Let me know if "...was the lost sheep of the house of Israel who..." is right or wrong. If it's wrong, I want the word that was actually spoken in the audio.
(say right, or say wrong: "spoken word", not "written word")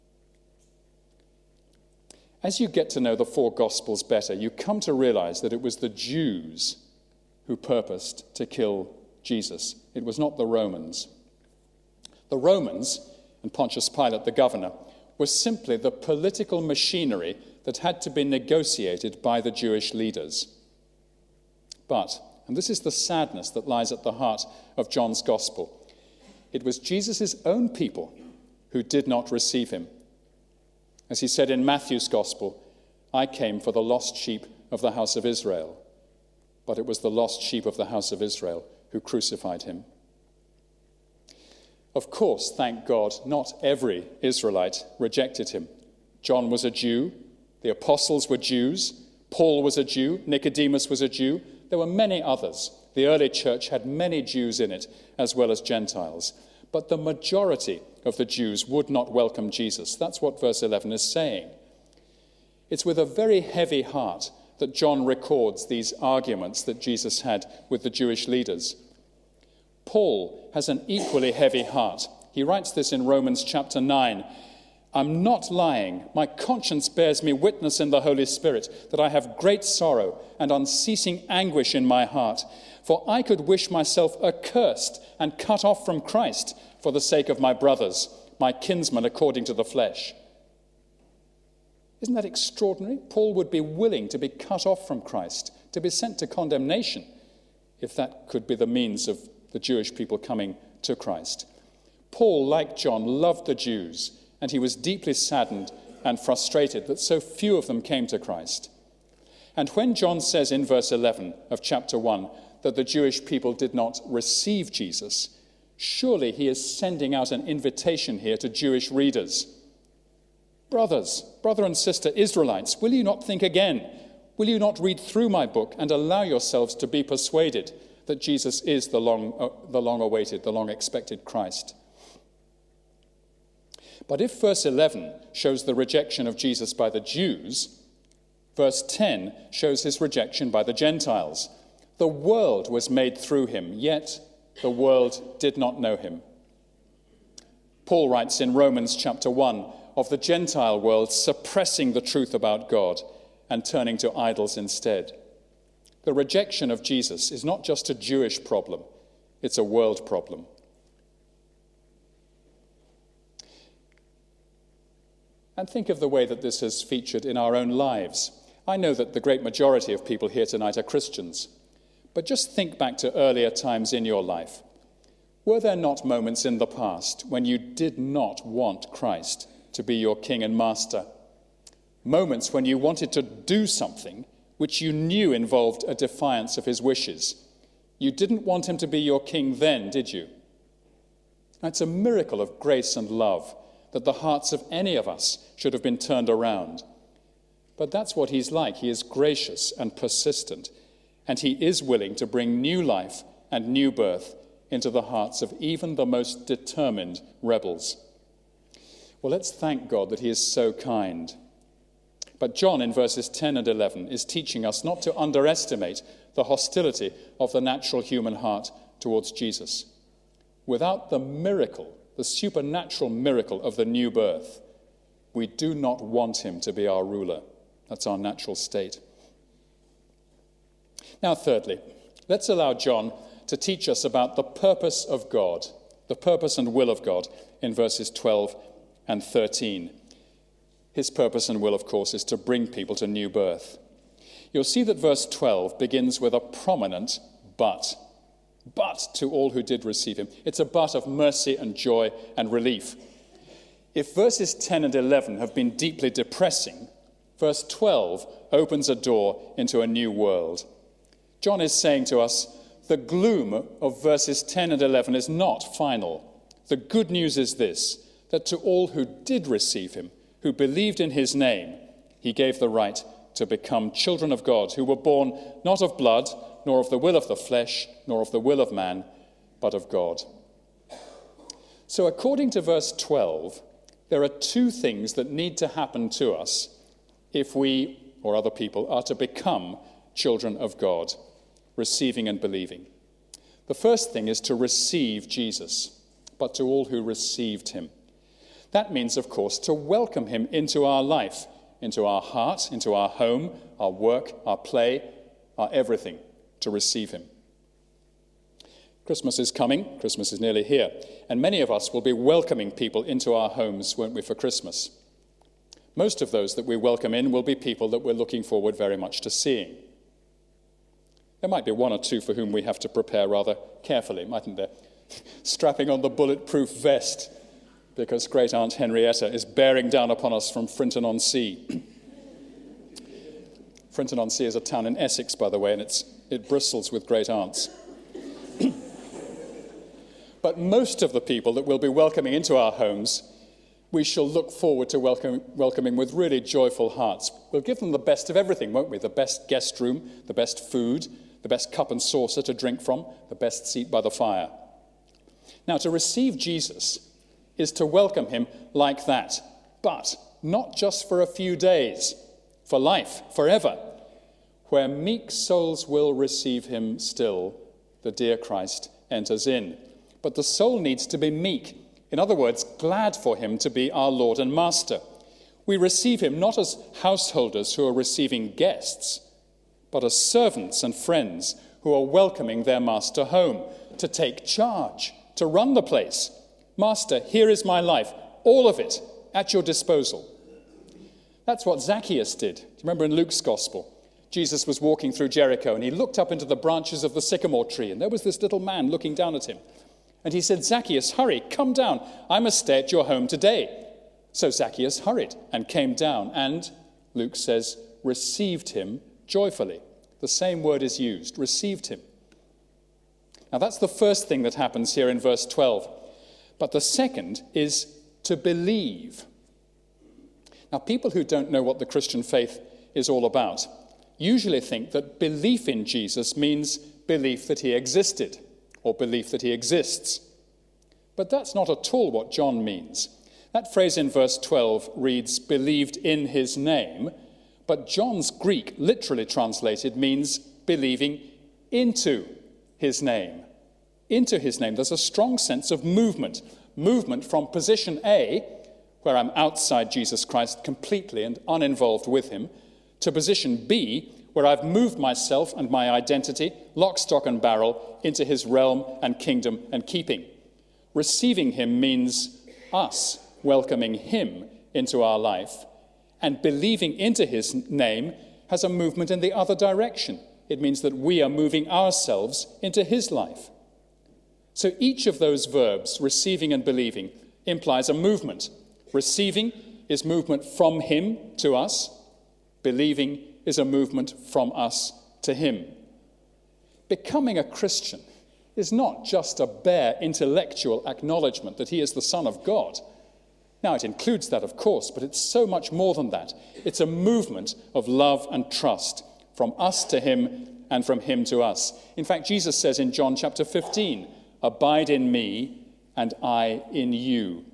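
right.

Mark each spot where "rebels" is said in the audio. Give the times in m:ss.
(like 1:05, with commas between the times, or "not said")
3:27.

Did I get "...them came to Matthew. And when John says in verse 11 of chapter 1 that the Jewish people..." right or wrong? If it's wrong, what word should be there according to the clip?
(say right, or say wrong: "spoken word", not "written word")
wrong: "Christ", not "Matthew".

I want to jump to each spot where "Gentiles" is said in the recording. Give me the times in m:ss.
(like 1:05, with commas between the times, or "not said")
0:55, 2:20, 2:30.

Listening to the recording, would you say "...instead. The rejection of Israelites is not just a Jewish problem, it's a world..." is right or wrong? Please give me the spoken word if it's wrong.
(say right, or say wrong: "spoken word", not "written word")
wrong: "Jesus", not "Israelites".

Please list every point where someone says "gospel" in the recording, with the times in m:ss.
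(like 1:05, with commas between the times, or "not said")
0:03, 0:25, 0:32, 6:33.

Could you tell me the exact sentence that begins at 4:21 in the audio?
John is saying to us the gloom of verses 10 and 11 is not final.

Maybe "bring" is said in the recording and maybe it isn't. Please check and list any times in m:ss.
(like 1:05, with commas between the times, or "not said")
3:22, 4:02.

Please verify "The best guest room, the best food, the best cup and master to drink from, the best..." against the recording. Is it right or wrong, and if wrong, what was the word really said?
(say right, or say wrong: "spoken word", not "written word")
wrong: "saucer", not "master".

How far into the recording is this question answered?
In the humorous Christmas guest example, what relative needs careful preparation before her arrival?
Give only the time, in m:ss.
5:28.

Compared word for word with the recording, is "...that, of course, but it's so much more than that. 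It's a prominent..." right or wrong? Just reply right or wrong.
wrong.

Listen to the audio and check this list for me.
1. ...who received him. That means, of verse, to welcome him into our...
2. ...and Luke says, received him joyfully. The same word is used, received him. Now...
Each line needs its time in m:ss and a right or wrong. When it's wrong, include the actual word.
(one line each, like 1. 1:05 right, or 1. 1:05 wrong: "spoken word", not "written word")
1. 4:56 wrong: "course", not "verse"
2. 6:46 right.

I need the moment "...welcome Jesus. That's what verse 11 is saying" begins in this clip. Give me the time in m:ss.
0:59.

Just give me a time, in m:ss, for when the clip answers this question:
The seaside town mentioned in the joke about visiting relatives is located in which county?
5:34.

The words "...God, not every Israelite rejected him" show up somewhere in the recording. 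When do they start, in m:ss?
0:42.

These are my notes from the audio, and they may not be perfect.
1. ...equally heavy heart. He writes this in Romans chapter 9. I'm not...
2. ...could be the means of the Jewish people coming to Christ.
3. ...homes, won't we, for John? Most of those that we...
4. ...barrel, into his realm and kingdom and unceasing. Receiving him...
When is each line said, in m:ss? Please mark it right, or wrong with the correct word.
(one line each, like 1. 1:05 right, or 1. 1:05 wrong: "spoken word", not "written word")
1. 1:10 right
2. 1:38 right
3. 5:13 wrong: "Christmas", not "John"
4. 7:37 wrong: "keeping", not "unceasing".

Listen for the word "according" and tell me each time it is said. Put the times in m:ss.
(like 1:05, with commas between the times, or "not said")
1:29, 4:42.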